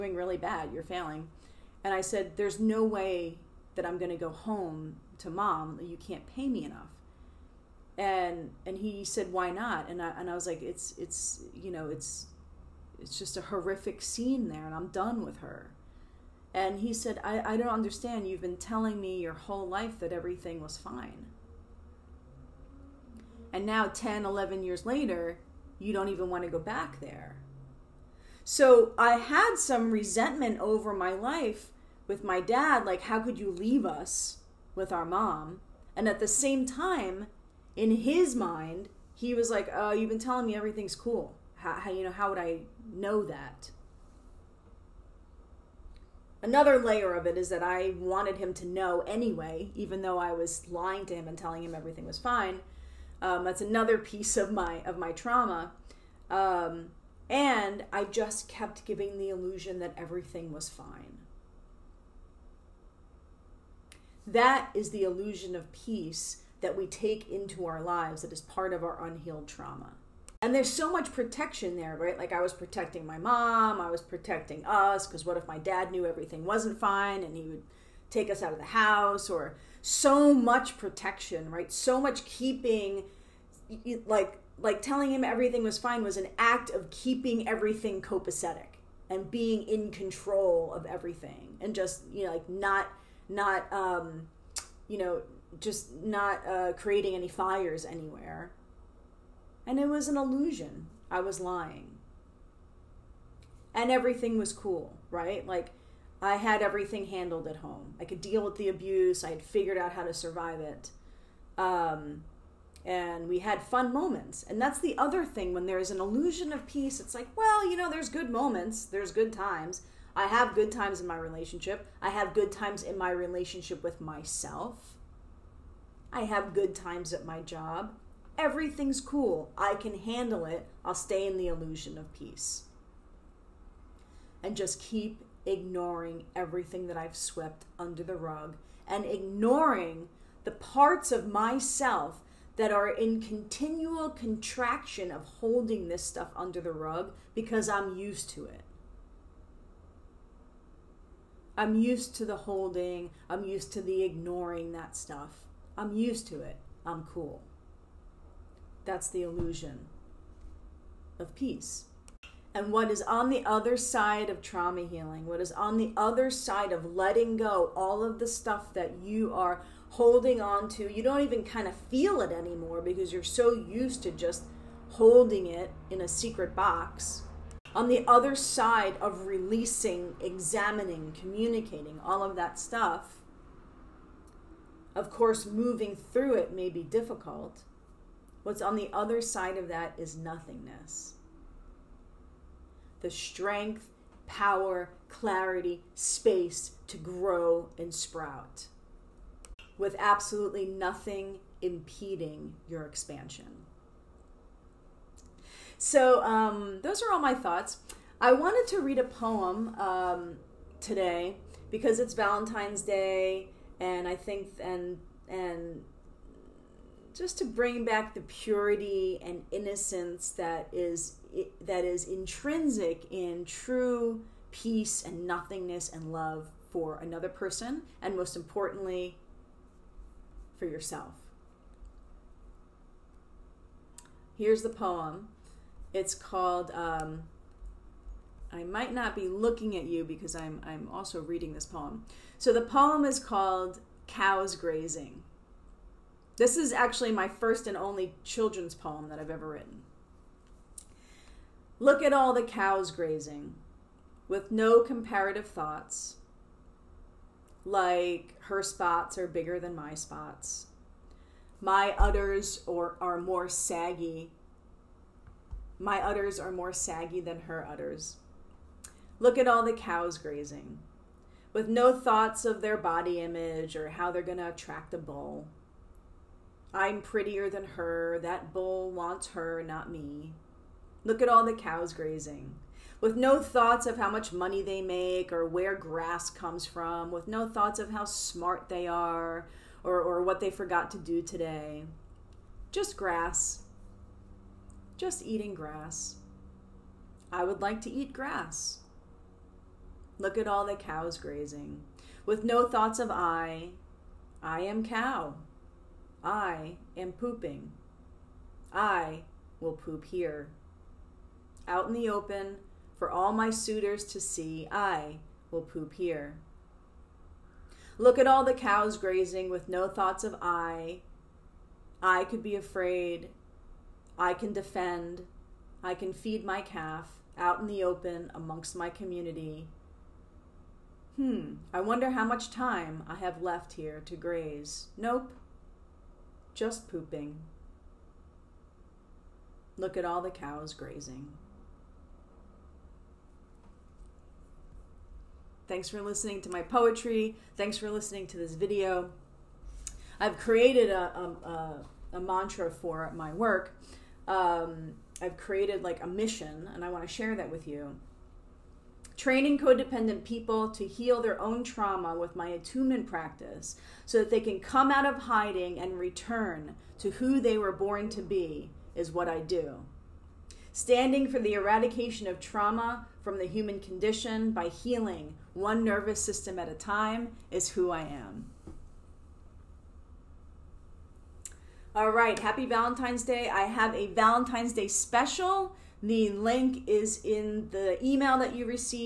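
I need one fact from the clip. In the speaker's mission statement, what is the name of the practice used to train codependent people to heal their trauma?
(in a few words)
attunement practice.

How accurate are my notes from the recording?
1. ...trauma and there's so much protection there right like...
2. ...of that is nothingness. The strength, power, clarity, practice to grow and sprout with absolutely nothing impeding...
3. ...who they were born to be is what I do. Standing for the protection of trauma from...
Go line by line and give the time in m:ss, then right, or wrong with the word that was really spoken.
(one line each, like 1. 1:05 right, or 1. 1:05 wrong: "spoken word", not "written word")
1. 1:09 right
2. 3:09 wrong: "space", not "practice"
3. 6:07 wrong: "eradication", not "protection".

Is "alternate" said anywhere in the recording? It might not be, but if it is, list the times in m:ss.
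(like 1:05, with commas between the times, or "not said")
not said.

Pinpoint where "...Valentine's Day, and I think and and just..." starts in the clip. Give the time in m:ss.
3:32.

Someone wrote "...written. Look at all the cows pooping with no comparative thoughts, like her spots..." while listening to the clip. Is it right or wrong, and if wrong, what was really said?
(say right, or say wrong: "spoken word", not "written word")
wrong: "grazing", not "pooping".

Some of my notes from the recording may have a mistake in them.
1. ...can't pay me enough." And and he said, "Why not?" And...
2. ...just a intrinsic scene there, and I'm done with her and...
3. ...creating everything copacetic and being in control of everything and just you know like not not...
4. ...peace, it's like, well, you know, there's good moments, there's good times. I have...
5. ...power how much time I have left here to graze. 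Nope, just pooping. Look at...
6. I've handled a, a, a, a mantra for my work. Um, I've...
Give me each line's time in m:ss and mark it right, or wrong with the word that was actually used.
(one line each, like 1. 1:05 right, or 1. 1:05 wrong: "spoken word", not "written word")
1. 0:05 right
2. 0:13 wrong: "horrific", not "intrinsic"
3. 1:26 wrong: "keeping", not "creating"
4. 1:56 right
5. 5:31 wrong: "wonder", not "power"
6. 5:50 wrong: "created", not "handled".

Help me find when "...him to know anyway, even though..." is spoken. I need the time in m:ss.
0:48.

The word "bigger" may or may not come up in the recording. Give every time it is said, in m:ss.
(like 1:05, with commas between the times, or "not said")
4:19.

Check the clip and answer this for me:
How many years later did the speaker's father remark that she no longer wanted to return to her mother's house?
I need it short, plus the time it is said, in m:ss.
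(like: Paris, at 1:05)
10, 11 years, at 0:23.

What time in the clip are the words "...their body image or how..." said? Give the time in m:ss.
4:32.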